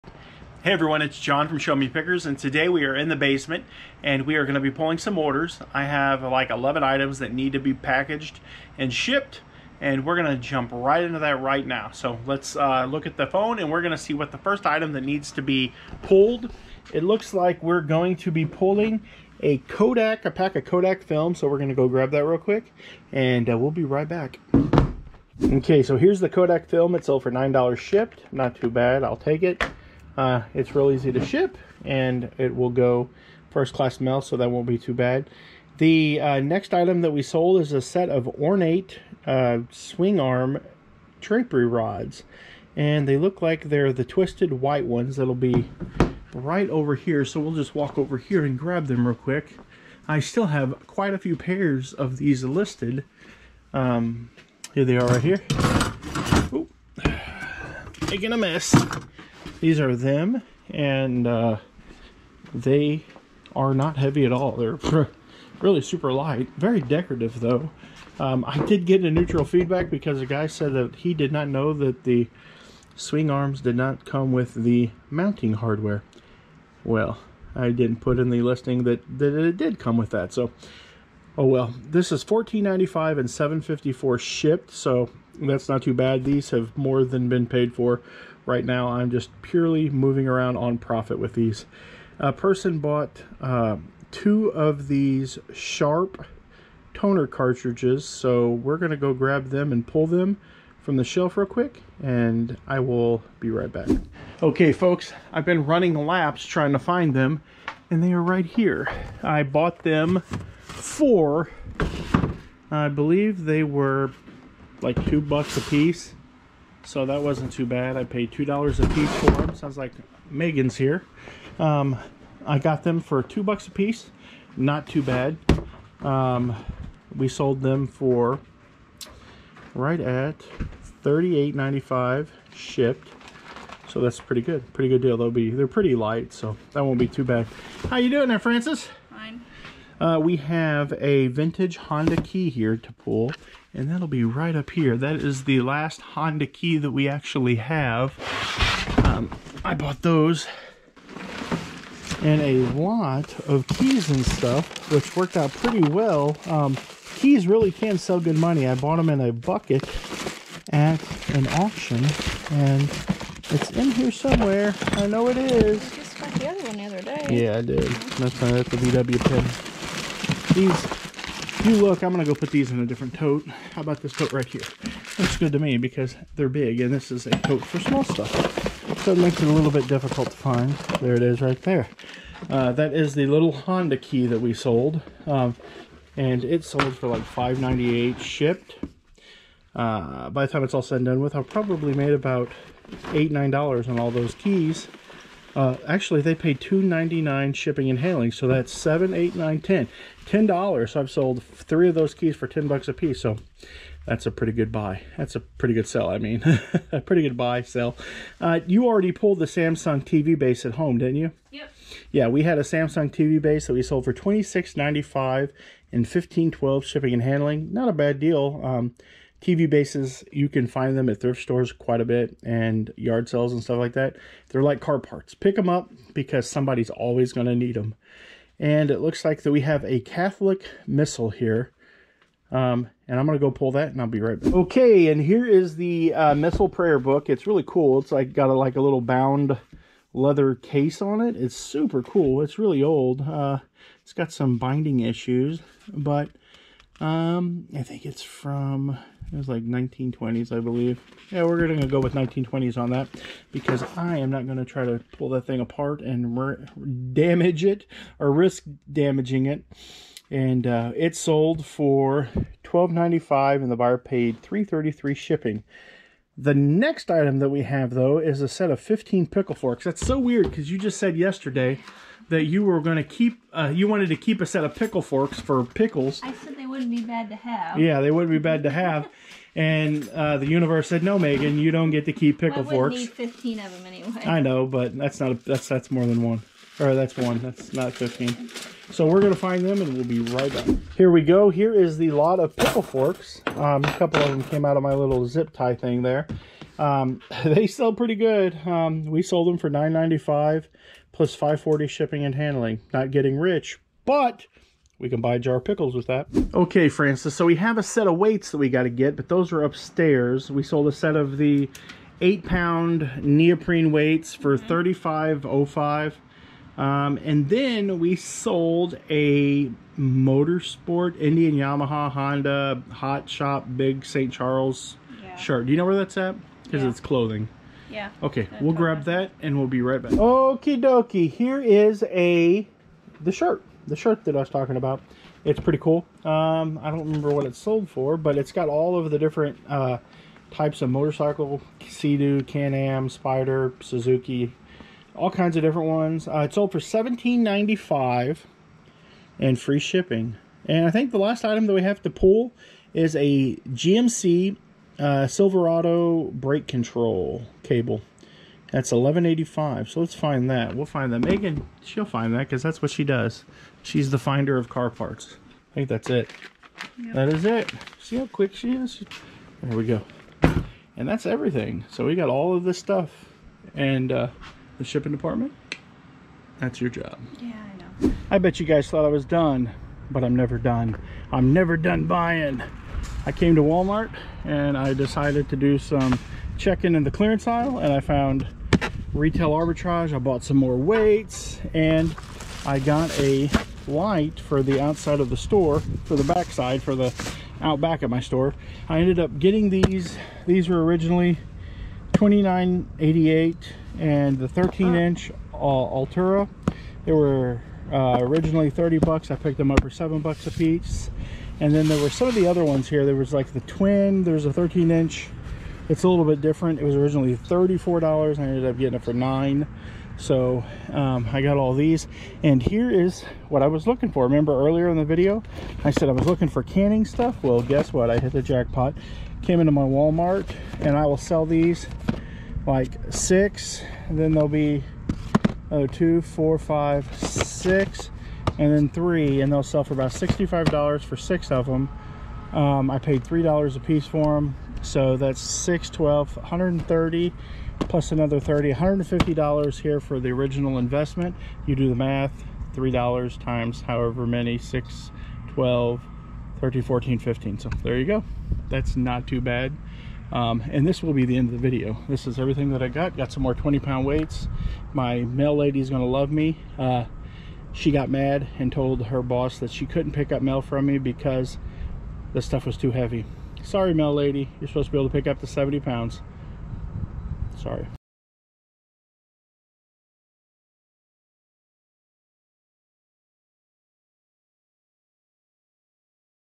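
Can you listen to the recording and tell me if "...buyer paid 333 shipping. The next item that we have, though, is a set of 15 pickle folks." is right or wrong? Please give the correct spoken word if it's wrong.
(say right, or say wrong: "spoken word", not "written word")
wrong: "forks", not "folks".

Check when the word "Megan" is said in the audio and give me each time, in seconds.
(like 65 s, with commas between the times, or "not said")
120 s, 281 s, 361 s.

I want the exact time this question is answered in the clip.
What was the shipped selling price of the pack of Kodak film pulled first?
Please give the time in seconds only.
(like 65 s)
27 s.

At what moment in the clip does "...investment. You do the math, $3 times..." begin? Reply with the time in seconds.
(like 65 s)
450 s.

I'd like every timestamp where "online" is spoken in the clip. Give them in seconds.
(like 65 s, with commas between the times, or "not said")
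not said.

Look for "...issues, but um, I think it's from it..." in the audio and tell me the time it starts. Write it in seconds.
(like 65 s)
244 s.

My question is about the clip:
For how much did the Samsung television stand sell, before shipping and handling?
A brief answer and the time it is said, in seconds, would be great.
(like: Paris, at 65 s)
$26.95, at 214 s.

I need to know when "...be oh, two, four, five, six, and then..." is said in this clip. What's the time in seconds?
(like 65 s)
434 s.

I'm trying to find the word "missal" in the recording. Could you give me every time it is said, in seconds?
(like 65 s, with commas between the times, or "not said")
230 s, 236 s.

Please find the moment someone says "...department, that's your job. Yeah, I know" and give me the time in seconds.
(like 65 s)
375 s.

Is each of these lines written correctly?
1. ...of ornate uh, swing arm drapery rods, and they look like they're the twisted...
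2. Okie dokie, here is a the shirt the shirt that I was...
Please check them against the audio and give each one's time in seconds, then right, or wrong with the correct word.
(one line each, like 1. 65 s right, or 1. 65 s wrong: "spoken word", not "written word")
1. 38 s right
2. 330 s right.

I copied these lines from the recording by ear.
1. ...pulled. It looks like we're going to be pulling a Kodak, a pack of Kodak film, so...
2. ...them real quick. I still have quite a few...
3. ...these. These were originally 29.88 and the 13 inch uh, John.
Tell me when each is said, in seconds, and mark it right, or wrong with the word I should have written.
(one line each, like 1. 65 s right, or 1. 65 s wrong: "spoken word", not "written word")
1. 16 s right
2. 48 s right
3. 399 s wrong: "Altura", not "John".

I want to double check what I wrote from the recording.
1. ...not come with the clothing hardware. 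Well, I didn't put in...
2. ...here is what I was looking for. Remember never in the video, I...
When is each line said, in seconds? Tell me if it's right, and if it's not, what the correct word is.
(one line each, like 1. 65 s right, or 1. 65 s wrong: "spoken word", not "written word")
1. 73 s wrong: "mounting", not "clothing"
2. 422 s wrong: "earlier", not "never".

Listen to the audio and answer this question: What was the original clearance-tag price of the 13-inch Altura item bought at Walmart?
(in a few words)
$30.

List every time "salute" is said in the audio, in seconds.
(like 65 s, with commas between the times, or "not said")
not said.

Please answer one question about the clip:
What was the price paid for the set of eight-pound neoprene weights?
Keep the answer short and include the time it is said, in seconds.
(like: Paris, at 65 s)
$35.05, at 314 s.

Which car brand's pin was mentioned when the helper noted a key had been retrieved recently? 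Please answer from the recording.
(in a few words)
VW.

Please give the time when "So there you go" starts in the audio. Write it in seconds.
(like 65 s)
457 s.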